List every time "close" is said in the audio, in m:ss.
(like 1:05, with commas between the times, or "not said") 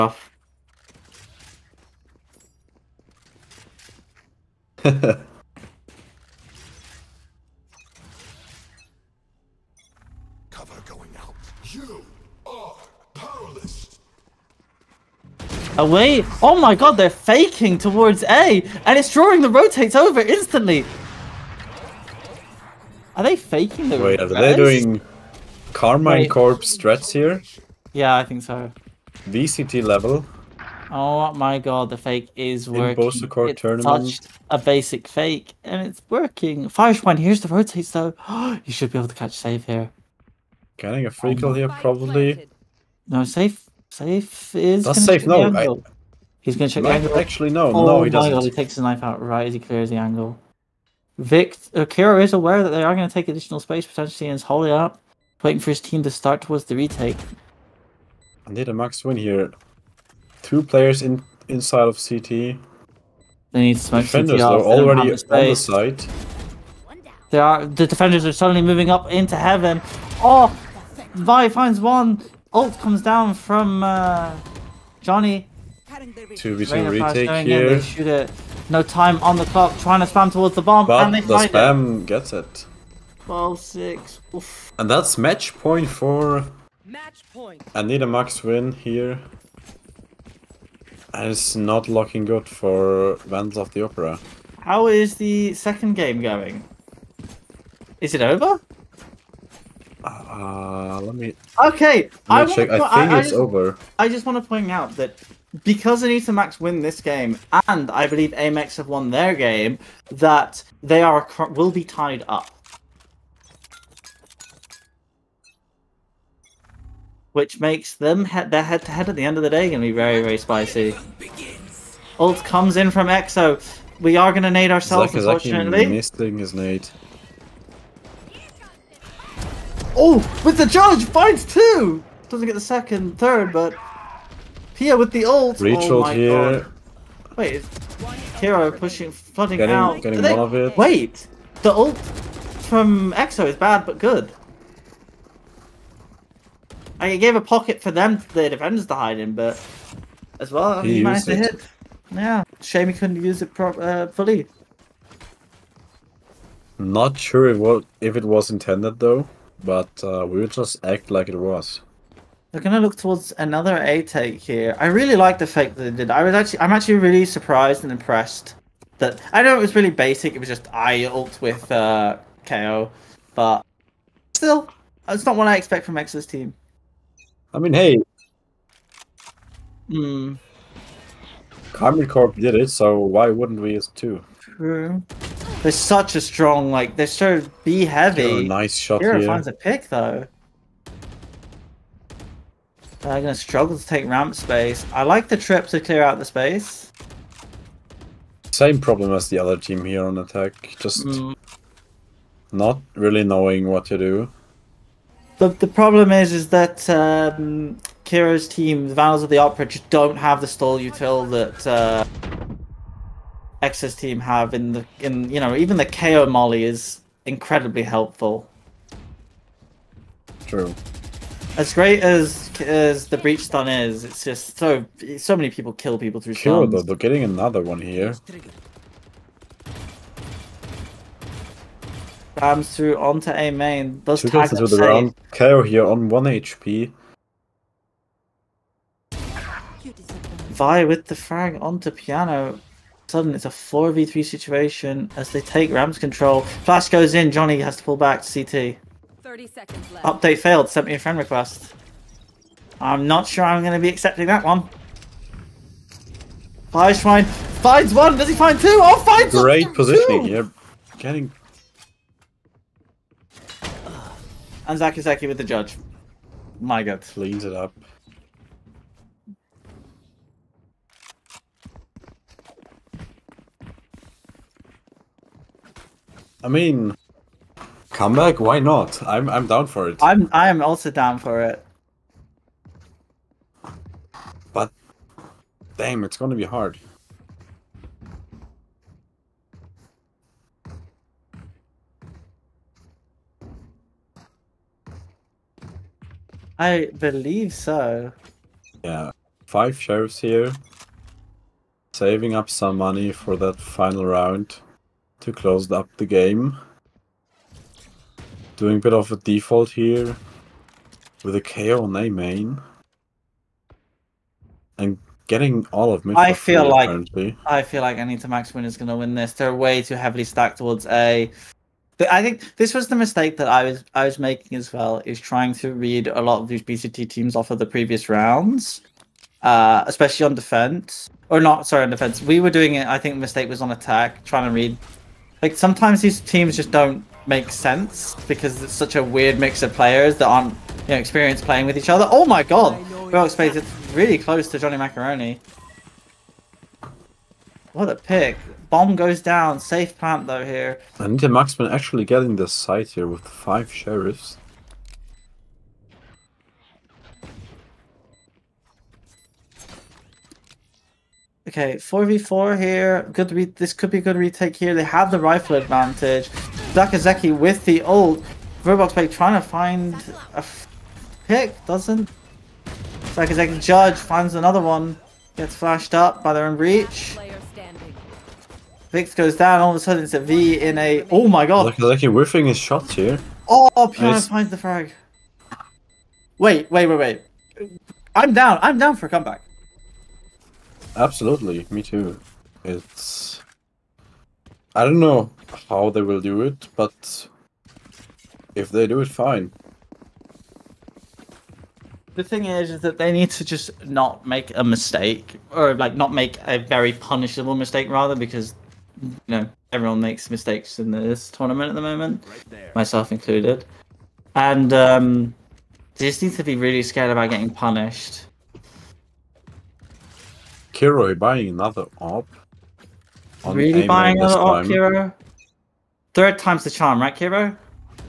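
5:05, 5:44.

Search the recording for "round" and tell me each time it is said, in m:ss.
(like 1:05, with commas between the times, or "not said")
3:54, 5:04, 5:28.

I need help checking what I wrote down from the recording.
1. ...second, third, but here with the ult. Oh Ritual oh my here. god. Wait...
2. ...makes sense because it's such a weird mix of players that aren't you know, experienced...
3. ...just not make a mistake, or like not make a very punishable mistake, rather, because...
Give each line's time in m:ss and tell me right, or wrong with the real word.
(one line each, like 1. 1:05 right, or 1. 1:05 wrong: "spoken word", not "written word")
1. 2:12 right
2. 5:37 right
3. 6:43 right.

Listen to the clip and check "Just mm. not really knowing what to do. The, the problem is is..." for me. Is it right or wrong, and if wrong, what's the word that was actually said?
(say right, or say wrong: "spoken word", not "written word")
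right.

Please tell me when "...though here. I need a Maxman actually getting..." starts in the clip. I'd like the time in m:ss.
5:50.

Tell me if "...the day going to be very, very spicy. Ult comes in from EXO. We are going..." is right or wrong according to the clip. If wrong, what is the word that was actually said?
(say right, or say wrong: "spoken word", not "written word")
right.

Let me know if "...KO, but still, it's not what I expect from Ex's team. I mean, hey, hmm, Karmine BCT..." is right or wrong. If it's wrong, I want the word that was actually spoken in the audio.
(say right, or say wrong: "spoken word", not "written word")
wrong: "Corp", not "BCT".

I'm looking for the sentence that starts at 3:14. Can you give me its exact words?
I like the trip to clear out the space.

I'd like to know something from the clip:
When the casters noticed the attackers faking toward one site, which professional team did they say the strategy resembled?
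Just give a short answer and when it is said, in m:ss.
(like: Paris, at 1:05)
Karmine Corp, at 0:25.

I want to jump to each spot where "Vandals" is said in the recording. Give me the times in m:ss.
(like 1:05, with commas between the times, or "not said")
1:33, 3:28.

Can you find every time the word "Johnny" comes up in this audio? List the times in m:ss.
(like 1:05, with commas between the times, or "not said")
1:15, 4:07, 5:44.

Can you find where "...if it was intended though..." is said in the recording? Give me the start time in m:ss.
2:37.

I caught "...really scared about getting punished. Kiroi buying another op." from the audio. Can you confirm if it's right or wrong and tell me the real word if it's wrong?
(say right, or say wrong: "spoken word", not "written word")
right.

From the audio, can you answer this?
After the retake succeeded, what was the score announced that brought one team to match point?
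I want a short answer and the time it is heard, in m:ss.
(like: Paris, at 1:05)
12-6, at 1:23.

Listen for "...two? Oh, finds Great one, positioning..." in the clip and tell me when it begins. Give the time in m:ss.
4:18.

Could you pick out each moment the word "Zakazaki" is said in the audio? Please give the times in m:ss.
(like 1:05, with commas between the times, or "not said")
4:24, 6:06, 6:13.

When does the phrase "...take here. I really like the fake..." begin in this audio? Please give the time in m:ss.
2:44.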